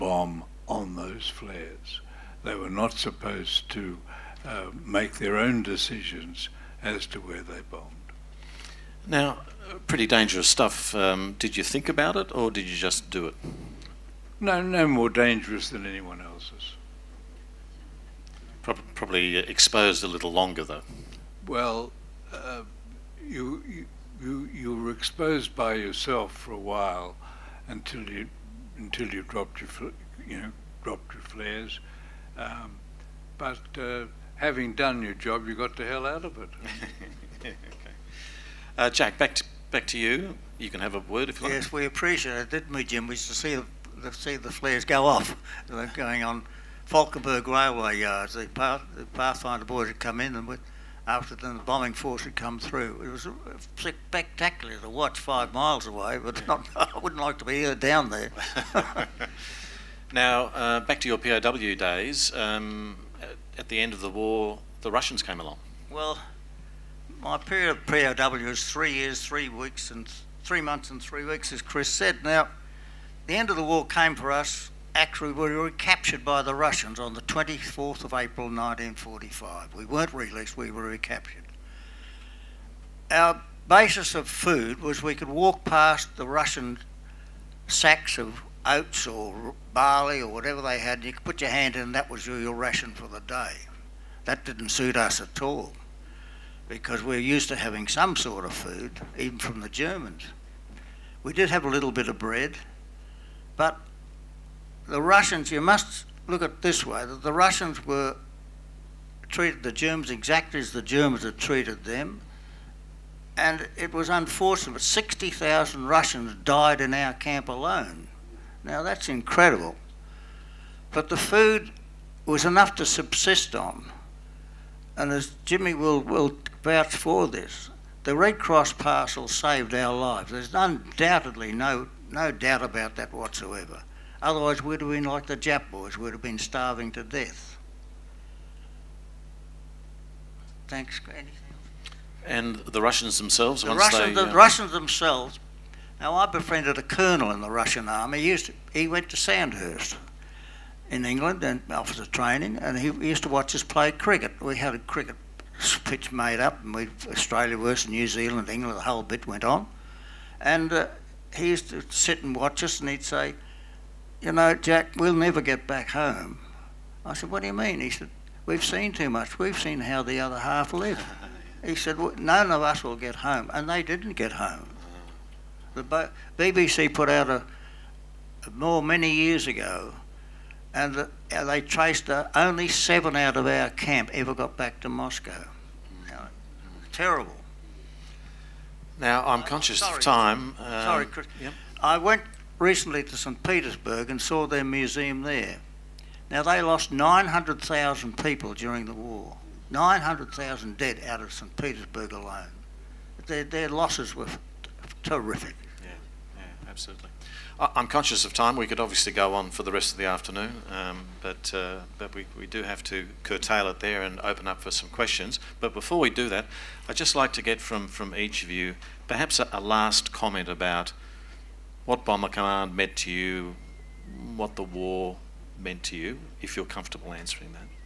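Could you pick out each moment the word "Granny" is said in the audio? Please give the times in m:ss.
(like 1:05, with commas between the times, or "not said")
2:20.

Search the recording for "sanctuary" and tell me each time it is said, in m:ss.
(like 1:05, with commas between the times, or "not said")
not said.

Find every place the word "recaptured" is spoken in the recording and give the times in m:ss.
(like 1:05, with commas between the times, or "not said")
1:15, 1:20.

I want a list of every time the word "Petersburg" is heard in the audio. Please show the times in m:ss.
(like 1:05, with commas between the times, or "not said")
3:13, 3:21.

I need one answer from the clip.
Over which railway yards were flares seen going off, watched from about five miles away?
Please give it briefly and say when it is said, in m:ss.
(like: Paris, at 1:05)
Falkenberg, at 0:46.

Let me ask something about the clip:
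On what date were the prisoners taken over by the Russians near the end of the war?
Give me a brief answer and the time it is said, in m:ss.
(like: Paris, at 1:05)
24 April 1945, at 1:17.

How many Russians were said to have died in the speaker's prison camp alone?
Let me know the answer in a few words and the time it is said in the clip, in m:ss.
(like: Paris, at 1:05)
60,000, at 1:54.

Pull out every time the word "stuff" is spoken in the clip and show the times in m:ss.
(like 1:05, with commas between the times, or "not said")
0:10.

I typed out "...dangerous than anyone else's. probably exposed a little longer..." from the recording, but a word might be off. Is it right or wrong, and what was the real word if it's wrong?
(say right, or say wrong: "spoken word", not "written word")
right.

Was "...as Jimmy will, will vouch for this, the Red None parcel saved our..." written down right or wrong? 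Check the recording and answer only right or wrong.
wrong.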